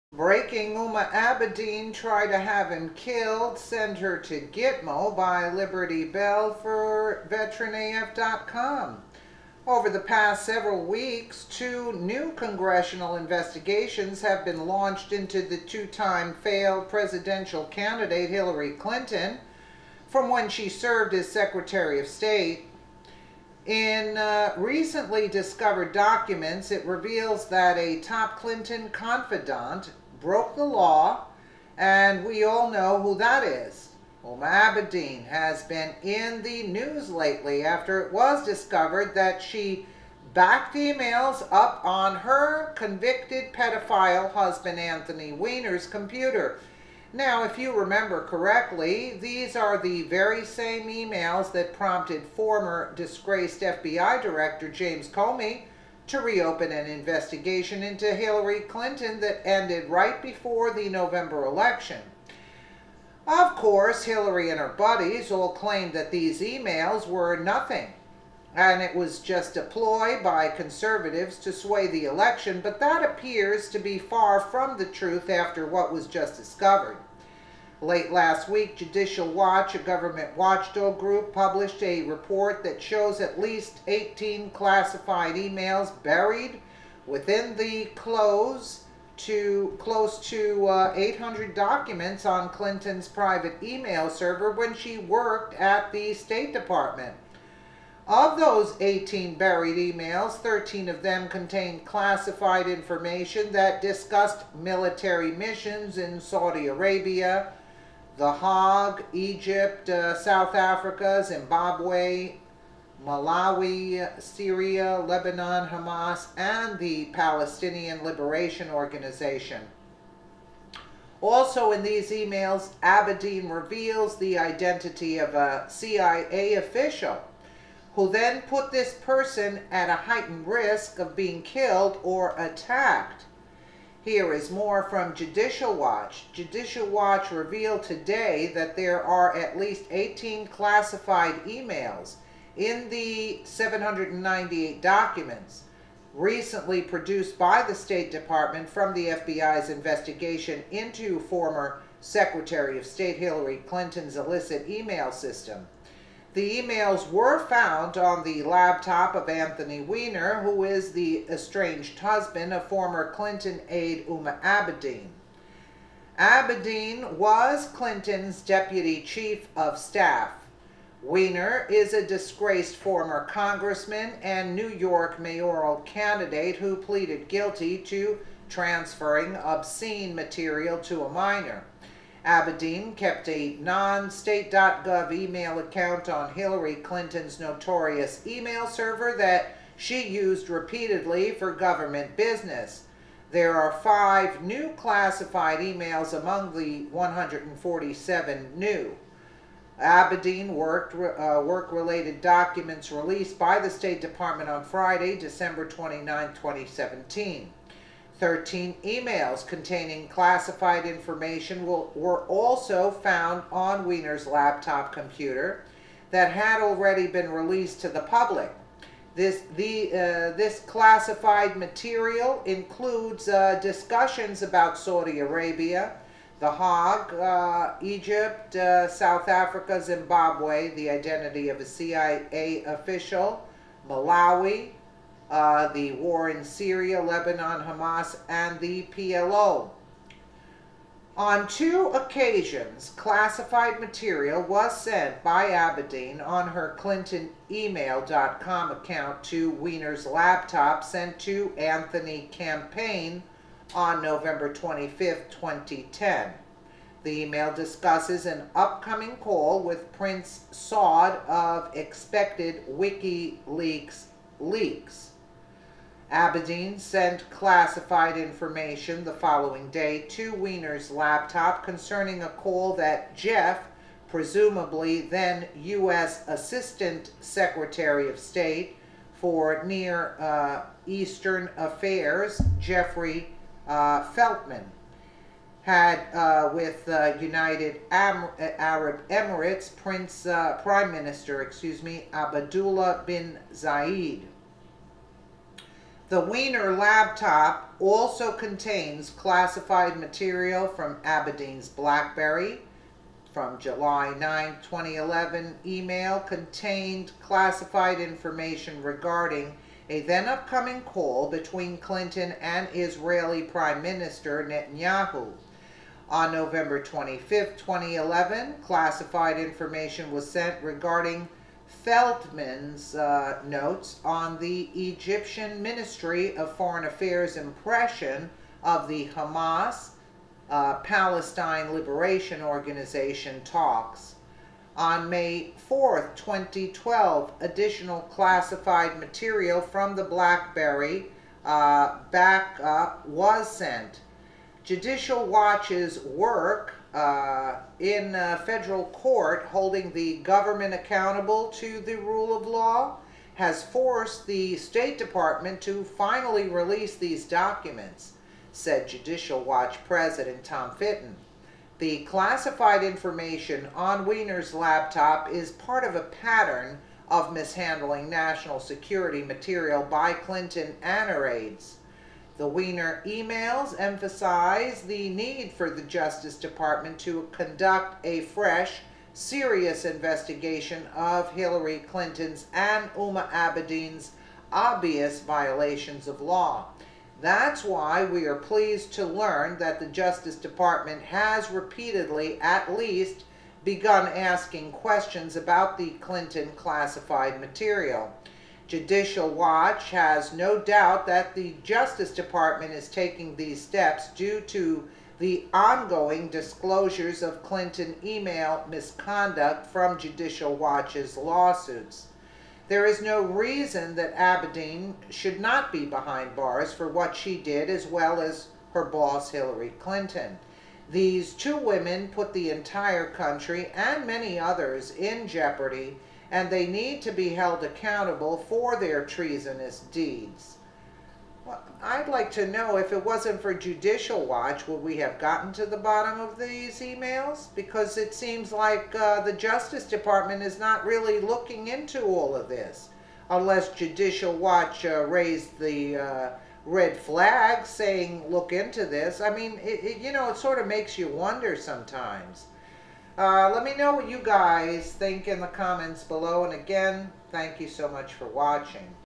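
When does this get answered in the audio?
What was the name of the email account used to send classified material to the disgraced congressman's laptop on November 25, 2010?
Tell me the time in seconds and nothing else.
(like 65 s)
251 s.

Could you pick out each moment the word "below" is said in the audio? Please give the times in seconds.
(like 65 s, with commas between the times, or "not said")
456 s.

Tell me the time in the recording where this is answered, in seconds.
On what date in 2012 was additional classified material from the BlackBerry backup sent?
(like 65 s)
335 s.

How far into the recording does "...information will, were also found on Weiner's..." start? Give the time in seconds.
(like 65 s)
210 s.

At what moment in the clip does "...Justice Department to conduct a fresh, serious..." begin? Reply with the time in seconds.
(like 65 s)
375 s.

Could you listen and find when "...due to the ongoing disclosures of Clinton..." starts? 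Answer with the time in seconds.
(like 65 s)
404 s.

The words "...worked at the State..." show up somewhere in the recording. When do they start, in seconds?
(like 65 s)
94 s.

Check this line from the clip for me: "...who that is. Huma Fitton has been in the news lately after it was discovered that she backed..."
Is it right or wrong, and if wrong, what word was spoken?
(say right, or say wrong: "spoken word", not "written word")
wrong: "Abedin", not "Fitton".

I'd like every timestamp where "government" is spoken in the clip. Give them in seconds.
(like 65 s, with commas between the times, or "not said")
79 s, 191 s, 350 s.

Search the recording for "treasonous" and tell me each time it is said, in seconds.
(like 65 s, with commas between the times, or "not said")
429 s.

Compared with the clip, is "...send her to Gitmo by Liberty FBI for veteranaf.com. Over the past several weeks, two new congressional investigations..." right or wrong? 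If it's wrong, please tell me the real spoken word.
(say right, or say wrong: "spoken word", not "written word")
wrong: "Bell", not "FBI".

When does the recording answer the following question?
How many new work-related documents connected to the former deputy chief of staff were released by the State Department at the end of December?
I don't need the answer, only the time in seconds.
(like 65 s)
196 s.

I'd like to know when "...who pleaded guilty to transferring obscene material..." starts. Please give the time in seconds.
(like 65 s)
176 s.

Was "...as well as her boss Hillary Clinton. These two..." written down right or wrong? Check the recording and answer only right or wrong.
right.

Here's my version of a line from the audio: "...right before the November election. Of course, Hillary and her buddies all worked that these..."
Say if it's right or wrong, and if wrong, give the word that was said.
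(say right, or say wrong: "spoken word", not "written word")
wrong: "claimed", not "worked".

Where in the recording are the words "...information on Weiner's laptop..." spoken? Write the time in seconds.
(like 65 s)
362 s.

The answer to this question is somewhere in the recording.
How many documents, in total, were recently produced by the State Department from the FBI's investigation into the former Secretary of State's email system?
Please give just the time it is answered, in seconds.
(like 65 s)
143 s.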